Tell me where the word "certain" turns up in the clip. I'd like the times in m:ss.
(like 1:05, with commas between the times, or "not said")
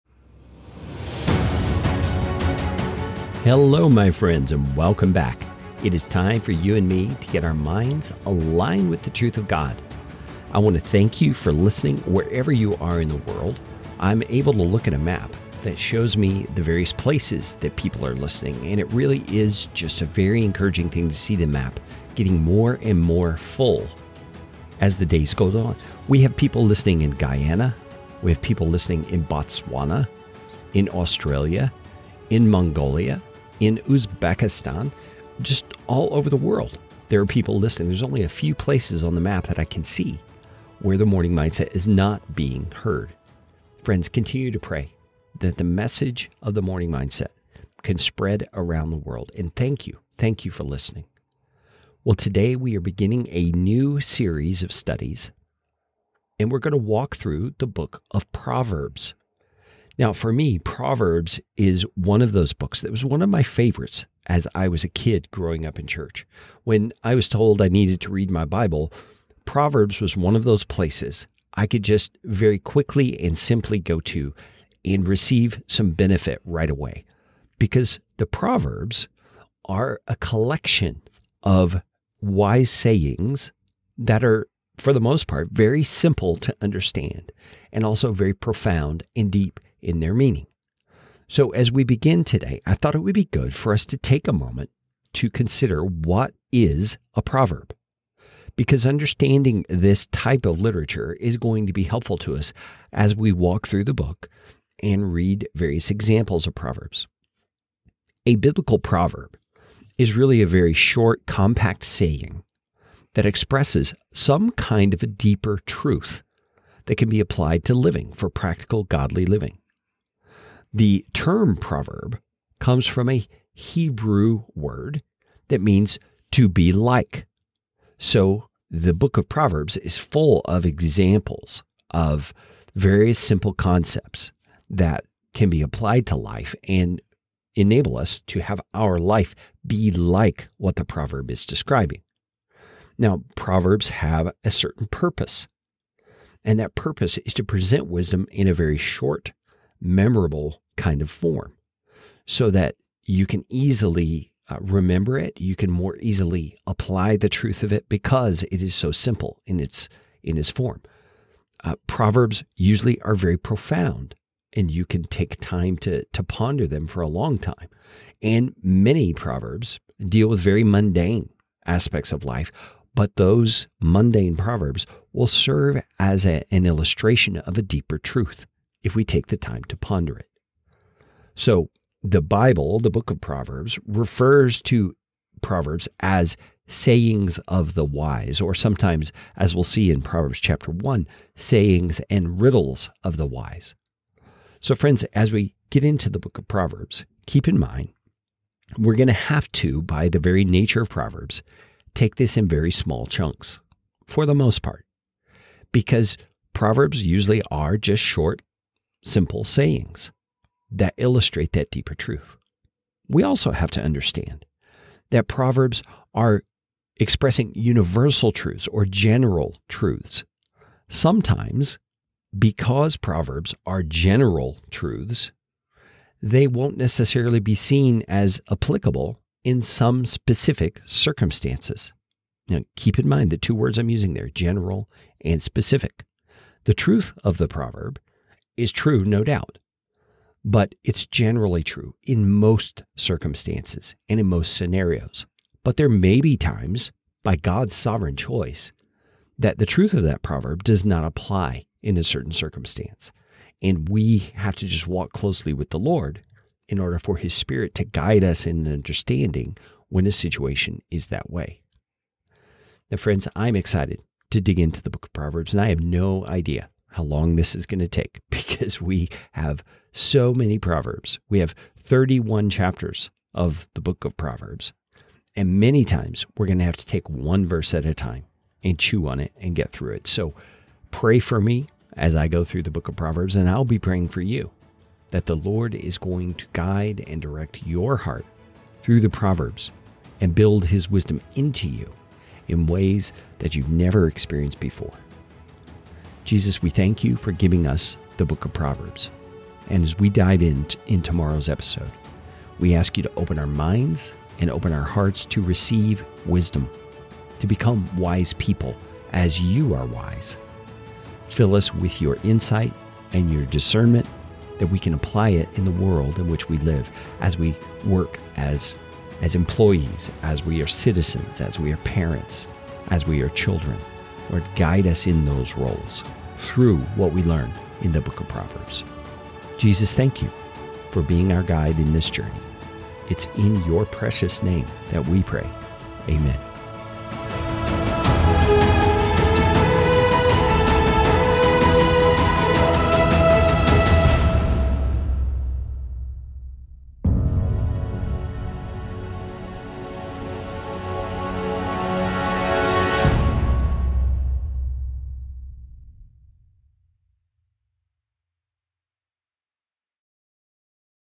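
2:24, 4:12.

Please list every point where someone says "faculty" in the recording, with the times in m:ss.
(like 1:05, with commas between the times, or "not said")
not said.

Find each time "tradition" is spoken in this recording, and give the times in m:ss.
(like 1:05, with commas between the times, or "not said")
not said.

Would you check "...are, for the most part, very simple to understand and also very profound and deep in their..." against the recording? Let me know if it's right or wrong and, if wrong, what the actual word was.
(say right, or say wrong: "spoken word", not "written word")
right.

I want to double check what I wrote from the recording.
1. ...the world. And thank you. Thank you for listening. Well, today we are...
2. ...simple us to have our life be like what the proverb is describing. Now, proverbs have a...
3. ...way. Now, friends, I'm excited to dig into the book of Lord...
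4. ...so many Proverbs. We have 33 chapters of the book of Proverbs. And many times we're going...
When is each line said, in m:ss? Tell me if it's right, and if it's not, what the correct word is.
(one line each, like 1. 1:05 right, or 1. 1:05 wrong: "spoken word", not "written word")
1. 0:48 right
2. 2:17 wrong: "enable", not "simple"
3. 4:21 wrong: "Proverbs", not "Lord"
4. 4:29 wrong: "31", not "33".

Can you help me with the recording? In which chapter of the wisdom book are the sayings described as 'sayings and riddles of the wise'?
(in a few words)
Chapter 1.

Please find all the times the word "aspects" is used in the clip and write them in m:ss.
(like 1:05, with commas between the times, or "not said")
2:51.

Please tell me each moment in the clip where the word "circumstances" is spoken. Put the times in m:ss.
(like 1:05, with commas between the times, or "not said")
3:50, 4:02, 4:12.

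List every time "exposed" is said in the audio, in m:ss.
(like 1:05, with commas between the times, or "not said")
not said.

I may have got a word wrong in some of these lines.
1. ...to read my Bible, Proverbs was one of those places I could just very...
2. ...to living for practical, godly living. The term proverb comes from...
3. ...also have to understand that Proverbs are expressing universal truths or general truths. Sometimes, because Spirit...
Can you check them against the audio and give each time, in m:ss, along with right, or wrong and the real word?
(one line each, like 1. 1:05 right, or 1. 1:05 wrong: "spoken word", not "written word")
1. 1:08 right
2. 1:57 right
3. 3:33 wrong: "Proverbs", not "Spirit".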